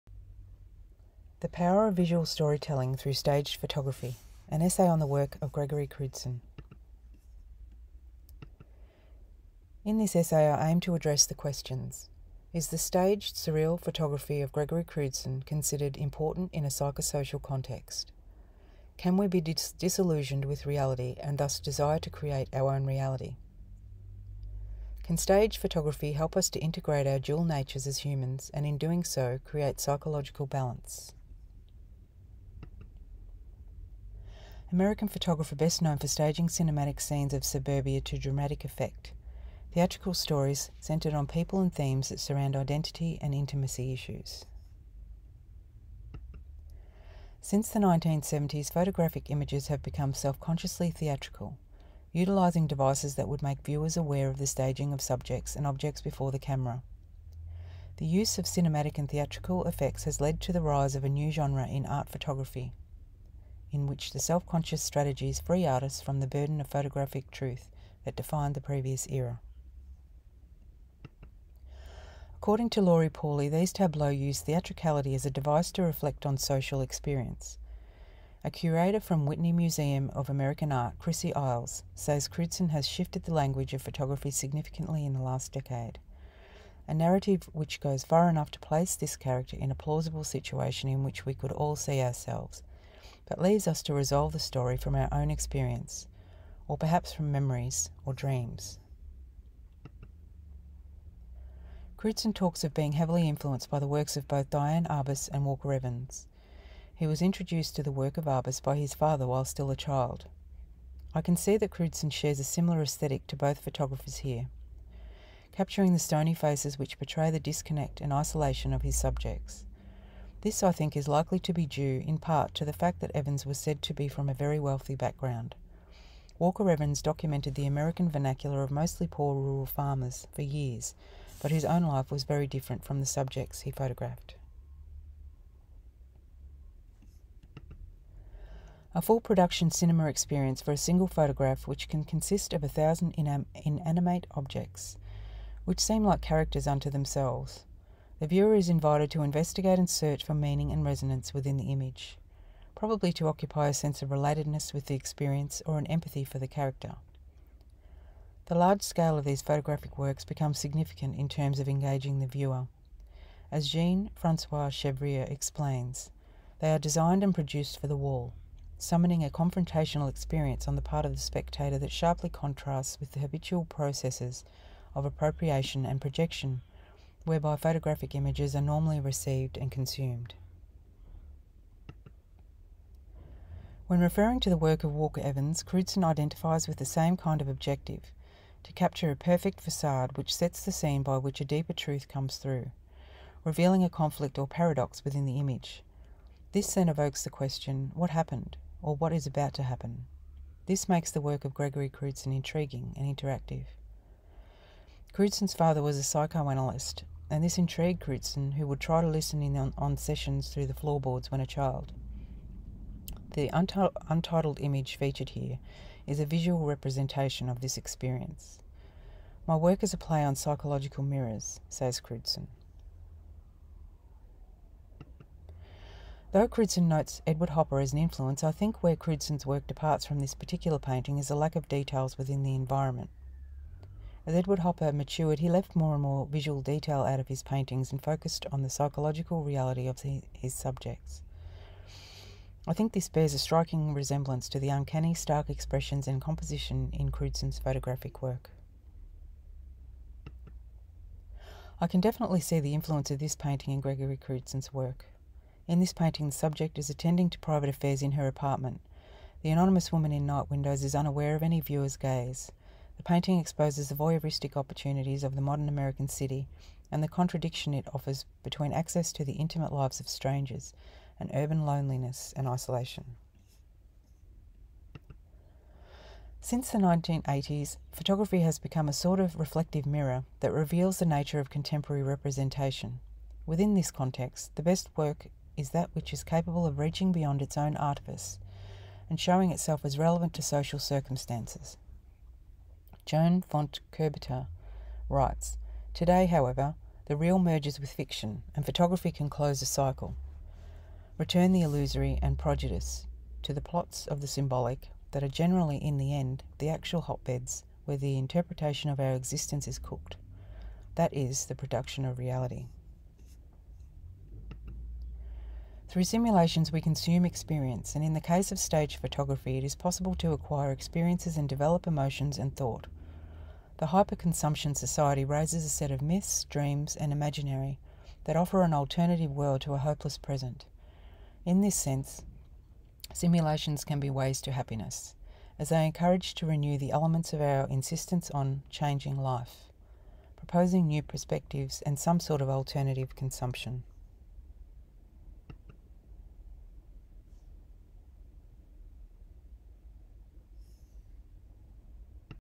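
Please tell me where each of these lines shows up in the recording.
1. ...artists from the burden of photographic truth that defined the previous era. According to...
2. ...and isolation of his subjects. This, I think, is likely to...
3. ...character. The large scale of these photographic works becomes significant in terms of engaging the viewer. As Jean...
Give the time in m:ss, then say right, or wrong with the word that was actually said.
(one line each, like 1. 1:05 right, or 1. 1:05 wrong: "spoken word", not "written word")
1. 1:05 right
2. 1:58 right
3. 2:36 right.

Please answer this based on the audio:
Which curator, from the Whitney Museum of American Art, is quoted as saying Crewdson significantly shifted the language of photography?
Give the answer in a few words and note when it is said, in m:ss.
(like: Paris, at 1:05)
Chrissie Iles, at 1:20.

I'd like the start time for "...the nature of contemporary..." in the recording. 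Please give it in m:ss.
4:40.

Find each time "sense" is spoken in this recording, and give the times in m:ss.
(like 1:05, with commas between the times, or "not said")
2:33, 5:31.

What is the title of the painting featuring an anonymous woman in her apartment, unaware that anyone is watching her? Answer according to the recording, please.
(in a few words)
Night Windows.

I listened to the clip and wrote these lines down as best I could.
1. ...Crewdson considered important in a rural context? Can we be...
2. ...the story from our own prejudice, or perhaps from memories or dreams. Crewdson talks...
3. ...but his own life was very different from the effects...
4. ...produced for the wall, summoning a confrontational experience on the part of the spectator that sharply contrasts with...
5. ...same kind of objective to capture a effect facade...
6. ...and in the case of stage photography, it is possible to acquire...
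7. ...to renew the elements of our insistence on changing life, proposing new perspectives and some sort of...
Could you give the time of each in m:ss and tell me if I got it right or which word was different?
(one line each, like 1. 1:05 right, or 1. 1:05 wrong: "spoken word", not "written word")
1. 0:14 wrong: "psychosocial", not "rural"
2. 1:34 wrong: "experience", not "prejudice"
3. 2:11 wrong: "subjects", not "effects"
4. 2:47 right
5. 3:06 wrong: "perfect", not "effect"
6. 5:17 right
7. 5:36 right.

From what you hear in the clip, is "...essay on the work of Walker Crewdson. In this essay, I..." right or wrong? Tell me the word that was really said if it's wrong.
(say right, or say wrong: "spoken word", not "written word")
wrong: "Gregory", not "Walker".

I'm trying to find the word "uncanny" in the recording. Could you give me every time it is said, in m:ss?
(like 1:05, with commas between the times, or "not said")
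4:04.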